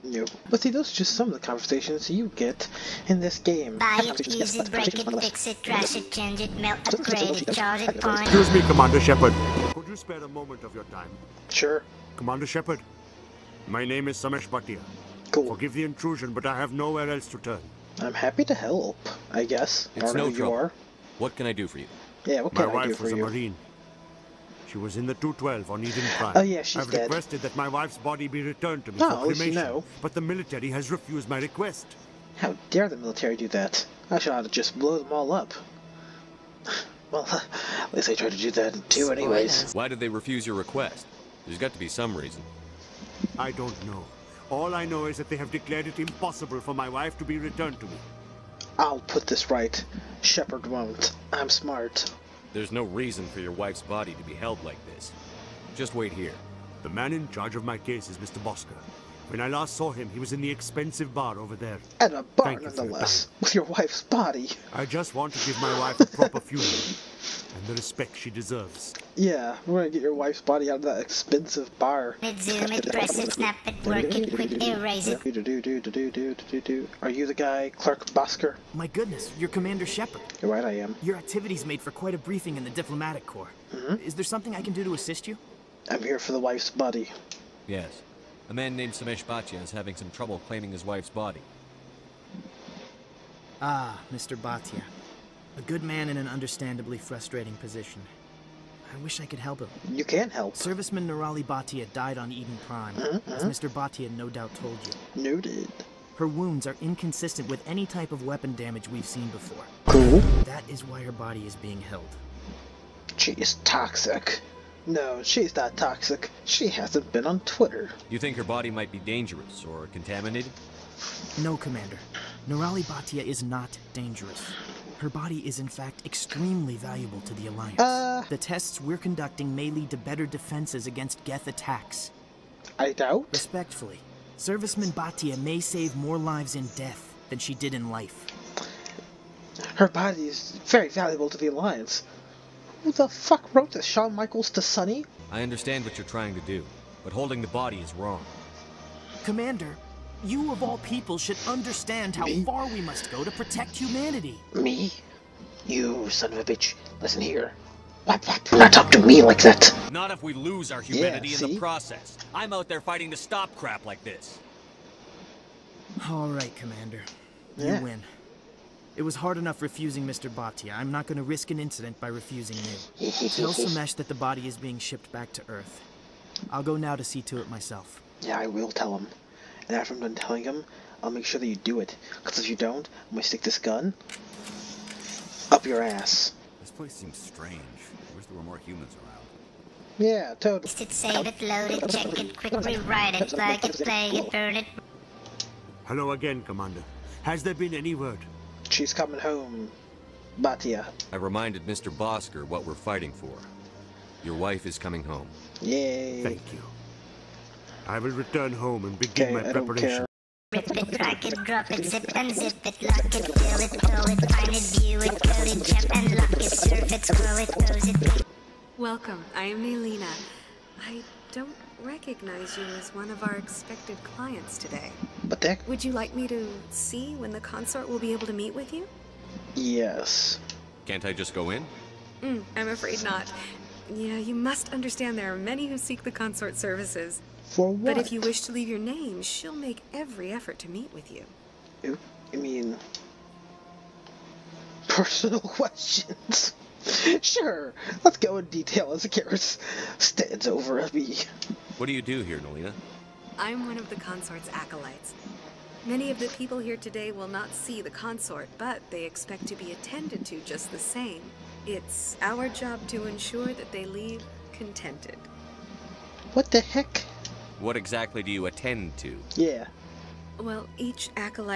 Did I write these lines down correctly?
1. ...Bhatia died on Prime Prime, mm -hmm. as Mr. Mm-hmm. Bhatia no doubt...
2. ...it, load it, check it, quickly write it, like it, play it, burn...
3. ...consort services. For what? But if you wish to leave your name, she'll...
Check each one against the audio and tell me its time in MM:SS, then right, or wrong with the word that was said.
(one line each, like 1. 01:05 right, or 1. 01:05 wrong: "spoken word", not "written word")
1. 01:41 wrong: "Eden", not "Prime"
2. 03:11 right
3. 03:56 right.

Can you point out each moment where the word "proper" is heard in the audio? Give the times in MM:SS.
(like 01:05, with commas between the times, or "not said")
01:06.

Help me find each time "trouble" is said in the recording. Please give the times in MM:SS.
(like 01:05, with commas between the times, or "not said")
00:20, 01:30.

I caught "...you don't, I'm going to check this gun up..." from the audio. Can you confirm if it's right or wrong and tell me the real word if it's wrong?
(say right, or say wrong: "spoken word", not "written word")
wrong: "stick", not "check".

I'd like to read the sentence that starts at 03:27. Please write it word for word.
I will return home and begin okay, my preparations.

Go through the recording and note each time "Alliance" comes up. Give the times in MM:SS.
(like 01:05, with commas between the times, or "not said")
02:07, 02:21.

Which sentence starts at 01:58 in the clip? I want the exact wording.
You think her body might be dangerous or contaminated?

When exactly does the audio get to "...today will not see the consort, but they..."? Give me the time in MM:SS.
04:16.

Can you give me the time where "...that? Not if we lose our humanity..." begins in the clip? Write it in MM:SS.
02:39.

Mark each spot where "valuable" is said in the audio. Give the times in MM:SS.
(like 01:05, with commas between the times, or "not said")
02:06, 02:20.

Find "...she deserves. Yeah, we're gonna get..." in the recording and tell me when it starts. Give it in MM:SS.
01:08.